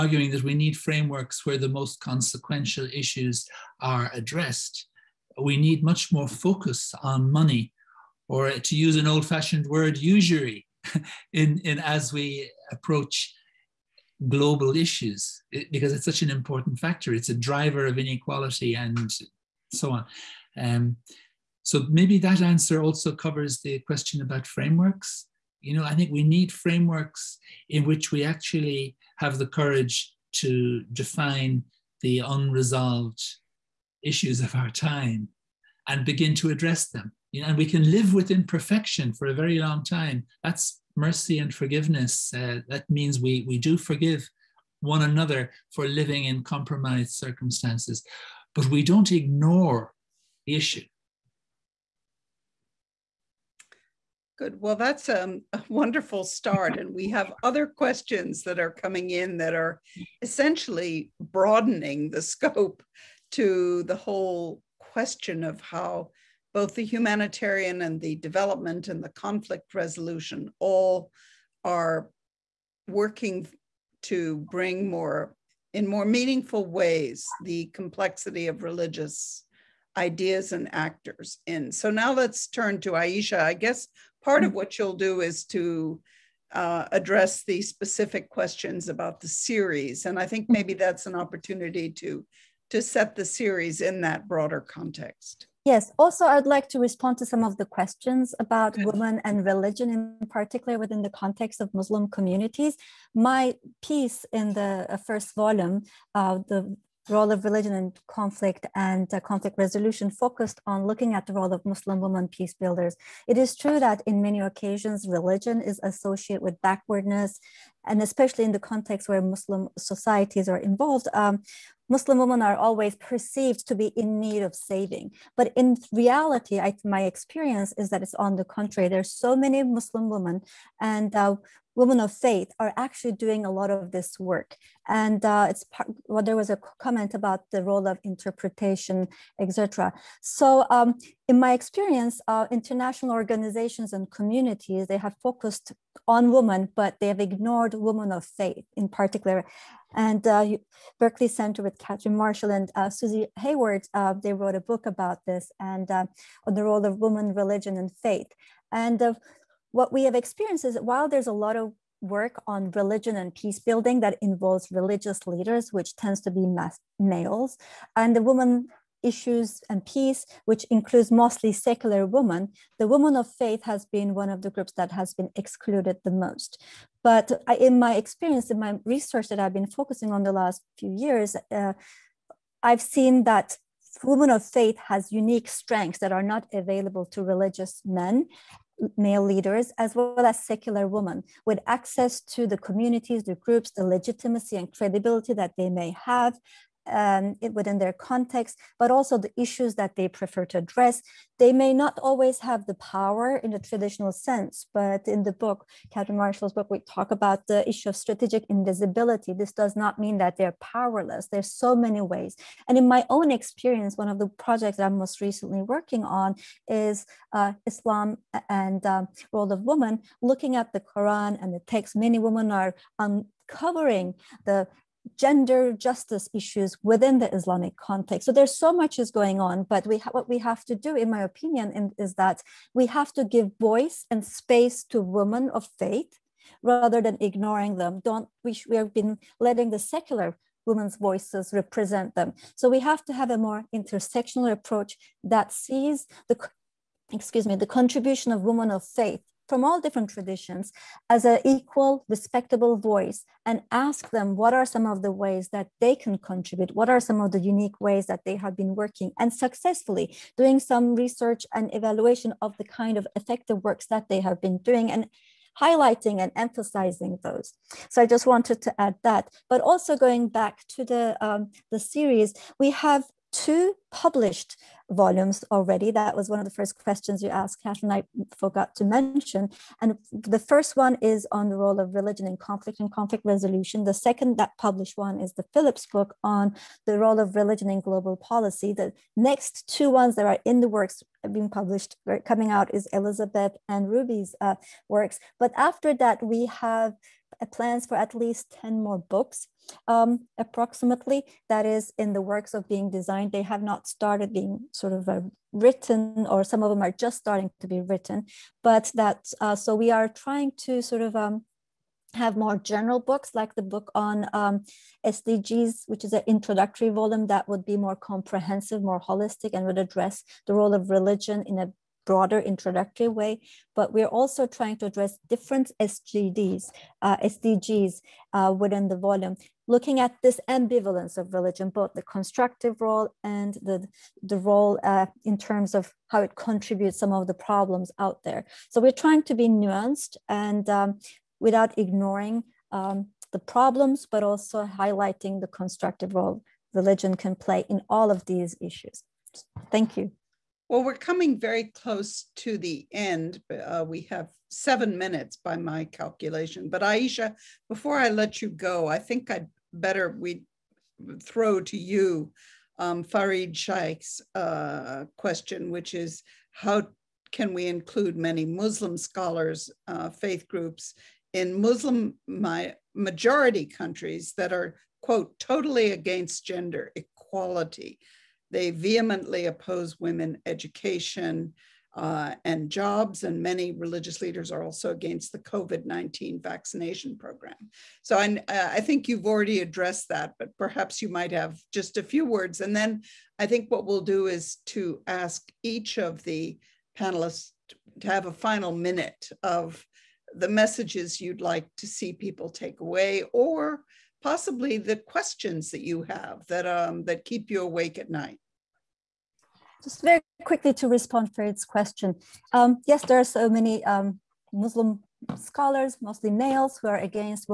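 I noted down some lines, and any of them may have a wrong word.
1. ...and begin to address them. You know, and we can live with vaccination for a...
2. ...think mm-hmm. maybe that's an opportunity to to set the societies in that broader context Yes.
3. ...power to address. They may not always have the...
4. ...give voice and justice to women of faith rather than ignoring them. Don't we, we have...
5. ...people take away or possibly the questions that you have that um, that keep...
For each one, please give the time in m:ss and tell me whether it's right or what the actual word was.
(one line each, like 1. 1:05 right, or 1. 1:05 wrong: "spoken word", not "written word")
1. 0:35 wrong: "imperfection", not "vaccination"
2. 1:30 wrong: "series", not "societies"
3. 3:20 wrong: "prefer", not "power"
4. 3:53 wrong: "space", not "justice"
5. 6:42 right.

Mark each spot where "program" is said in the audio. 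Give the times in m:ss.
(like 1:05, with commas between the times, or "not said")
6:27.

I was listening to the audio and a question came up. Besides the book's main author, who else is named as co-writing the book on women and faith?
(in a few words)
Susie Hayward.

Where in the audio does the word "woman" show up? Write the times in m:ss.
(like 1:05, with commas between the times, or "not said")
2:48, 2:52, 3:39.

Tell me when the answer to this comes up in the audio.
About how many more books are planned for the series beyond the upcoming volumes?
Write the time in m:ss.
4:58.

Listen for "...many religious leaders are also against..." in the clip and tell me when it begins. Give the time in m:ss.
6:23.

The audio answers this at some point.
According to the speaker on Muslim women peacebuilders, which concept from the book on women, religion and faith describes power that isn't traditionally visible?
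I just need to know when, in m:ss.
3:27.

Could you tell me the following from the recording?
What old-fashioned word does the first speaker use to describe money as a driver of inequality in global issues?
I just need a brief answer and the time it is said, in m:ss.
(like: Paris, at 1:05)
usury, at 0:09.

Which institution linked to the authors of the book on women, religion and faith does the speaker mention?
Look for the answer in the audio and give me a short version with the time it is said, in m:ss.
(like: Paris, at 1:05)
Berkley Center, at 2:30.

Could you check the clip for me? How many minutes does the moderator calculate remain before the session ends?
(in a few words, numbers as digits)
7.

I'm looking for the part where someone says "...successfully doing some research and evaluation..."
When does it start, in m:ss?
4:19.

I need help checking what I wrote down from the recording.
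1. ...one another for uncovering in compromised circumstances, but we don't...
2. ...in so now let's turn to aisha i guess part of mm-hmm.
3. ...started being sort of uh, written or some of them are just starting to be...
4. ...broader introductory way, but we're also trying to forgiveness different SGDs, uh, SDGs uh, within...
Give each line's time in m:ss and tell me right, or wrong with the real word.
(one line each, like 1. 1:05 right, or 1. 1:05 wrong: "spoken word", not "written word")
1. 0:44 wrong: "living", not "uncovering"
2. 1:21 right
3. 5:03 right
4. 5:22 wrong: "address", not "forgiveness".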